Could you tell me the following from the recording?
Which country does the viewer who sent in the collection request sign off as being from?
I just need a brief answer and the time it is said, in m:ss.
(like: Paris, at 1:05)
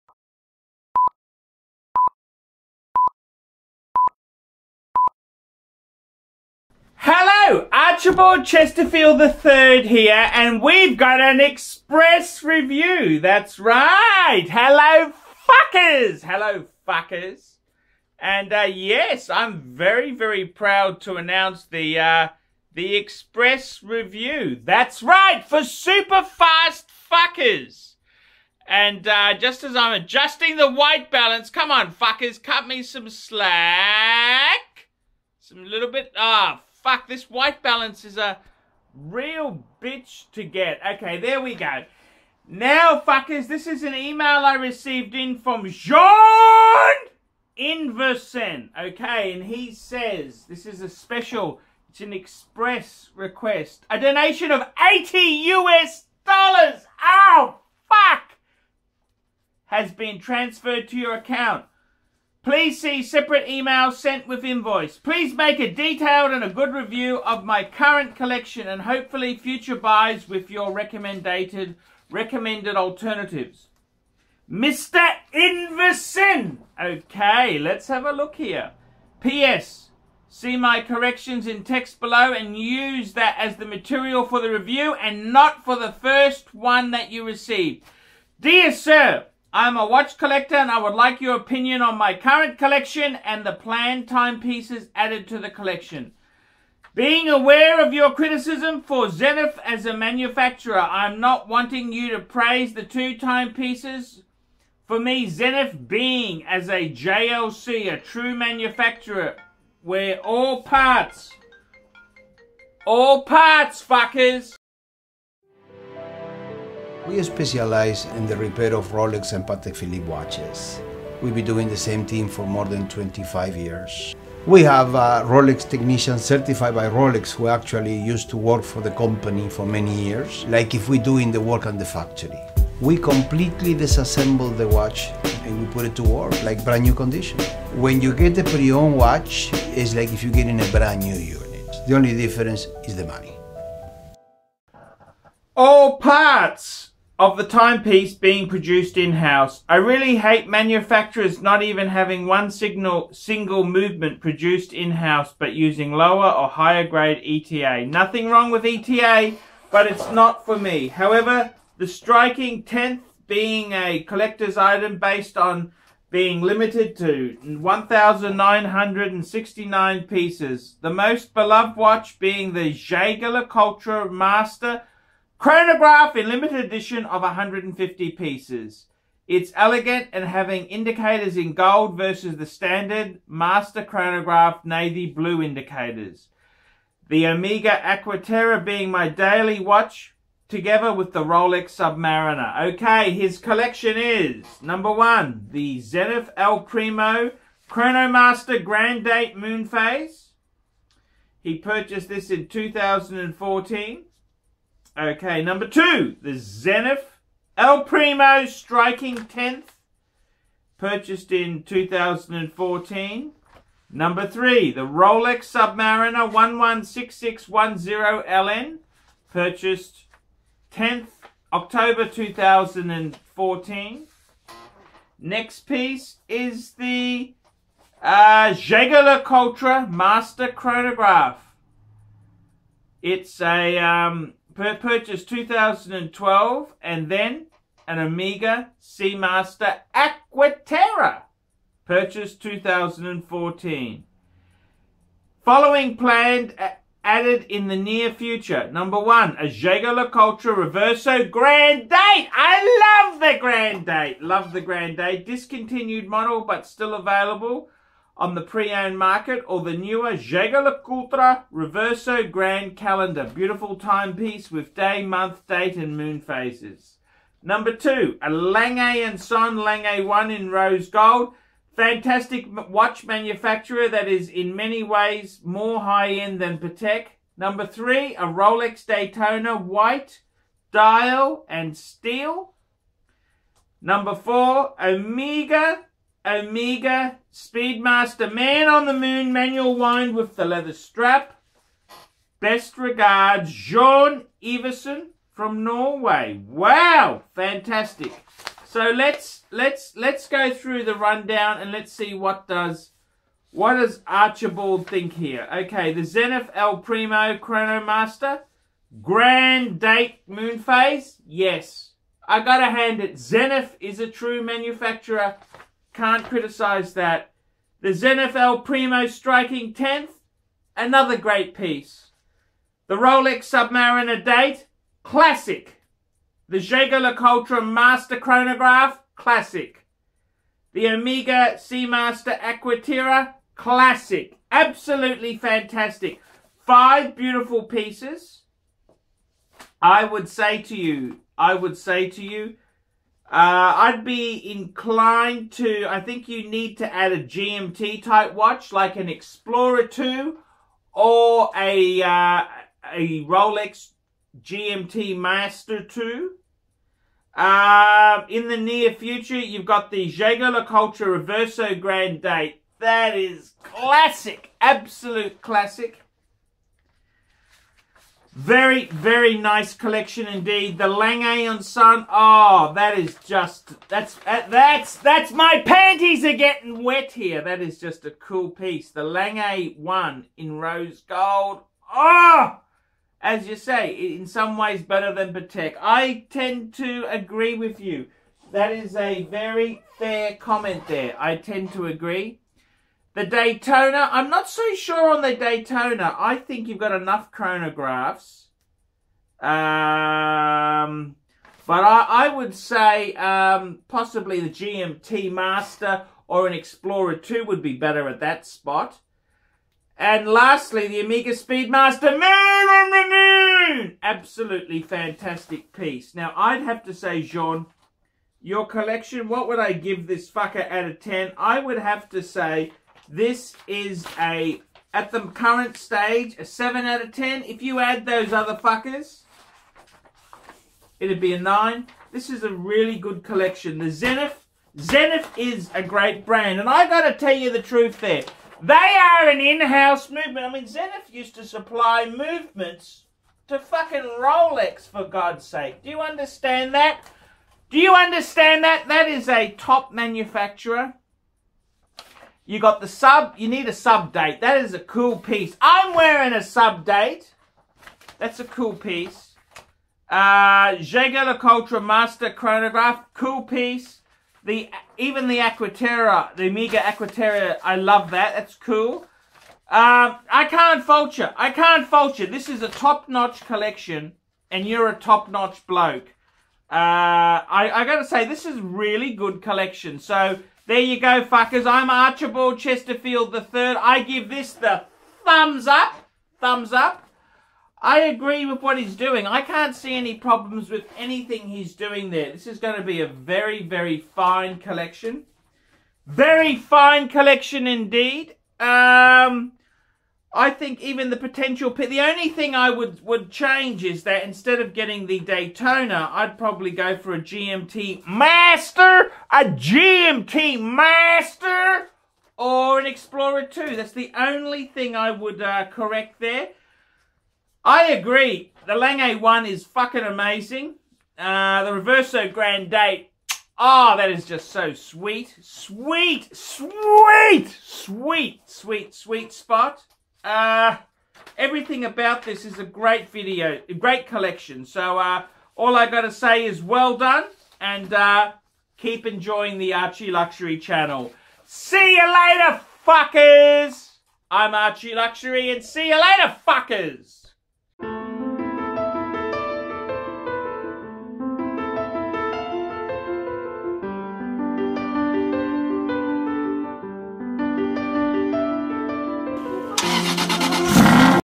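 Norway, at 4:55.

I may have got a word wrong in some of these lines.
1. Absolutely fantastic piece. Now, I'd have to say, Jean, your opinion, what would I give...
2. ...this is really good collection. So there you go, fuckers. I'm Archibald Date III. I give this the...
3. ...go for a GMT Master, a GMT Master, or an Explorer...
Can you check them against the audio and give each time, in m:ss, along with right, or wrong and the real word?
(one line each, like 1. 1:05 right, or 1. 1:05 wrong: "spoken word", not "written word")
1. 6:54 wrong: "collection", not "opinion"
2. 7:58 wrong: "Chesterfield", not "Date"
3. 8:26 right.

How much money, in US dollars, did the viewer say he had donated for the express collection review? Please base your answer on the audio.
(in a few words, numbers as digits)
80 US dollars.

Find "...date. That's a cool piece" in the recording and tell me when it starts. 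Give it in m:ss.
7:36.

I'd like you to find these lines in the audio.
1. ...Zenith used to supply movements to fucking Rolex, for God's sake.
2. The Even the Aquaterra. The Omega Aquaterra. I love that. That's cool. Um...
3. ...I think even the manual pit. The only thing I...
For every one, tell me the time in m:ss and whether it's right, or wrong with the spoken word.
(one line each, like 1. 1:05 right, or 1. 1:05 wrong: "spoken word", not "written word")
1. 7:20 right
2. 7:44 right
3. 8:20 wrong: "potential", not "manual".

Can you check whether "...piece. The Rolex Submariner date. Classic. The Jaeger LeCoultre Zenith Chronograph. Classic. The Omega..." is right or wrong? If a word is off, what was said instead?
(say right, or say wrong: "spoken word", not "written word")
wrong: "Master", not "Zenith".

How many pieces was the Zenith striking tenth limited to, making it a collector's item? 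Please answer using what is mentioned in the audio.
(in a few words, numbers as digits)
1,969.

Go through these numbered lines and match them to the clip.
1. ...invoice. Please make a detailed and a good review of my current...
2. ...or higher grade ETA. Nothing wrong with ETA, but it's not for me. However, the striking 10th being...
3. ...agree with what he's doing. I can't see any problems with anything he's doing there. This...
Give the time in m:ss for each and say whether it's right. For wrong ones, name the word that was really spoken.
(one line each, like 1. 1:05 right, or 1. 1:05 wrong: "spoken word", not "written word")
1. 1:04 right
2. 2:36 right
3. 8:08 right.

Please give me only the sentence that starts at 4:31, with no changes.
Fantastic watch manufacturer that is in many ways more high-end than Patek.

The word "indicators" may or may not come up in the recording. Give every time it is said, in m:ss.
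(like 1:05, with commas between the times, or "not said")
3:00, 3:05.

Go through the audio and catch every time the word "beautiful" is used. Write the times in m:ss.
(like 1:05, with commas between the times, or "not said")
4:23, 5:37.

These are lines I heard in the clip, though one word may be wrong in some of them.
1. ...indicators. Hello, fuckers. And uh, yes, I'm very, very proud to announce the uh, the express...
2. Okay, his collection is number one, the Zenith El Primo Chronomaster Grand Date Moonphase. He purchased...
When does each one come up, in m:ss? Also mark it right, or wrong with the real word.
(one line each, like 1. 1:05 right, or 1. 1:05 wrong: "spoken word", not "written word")
1. 0:15 wrong: "fuckers", not "indicators"
2. 3:12 right.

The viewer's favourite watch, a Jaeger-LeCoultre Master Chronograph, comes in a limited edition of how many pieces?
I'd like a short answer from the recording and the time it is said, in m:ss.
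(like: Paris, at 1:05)
150, at 2:57.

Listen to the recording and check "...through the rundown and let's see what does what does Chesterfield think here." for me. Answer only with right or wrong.
wrong.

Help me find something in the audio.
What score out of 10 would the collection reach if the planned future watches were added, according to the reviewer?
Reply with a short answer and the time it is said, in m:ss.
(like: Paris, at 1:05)
9, at 7:11.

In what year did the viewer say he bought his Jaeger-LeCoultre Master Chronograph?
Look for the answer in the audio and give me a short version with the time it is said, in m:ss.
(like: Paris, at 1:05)
2012, at 3:55.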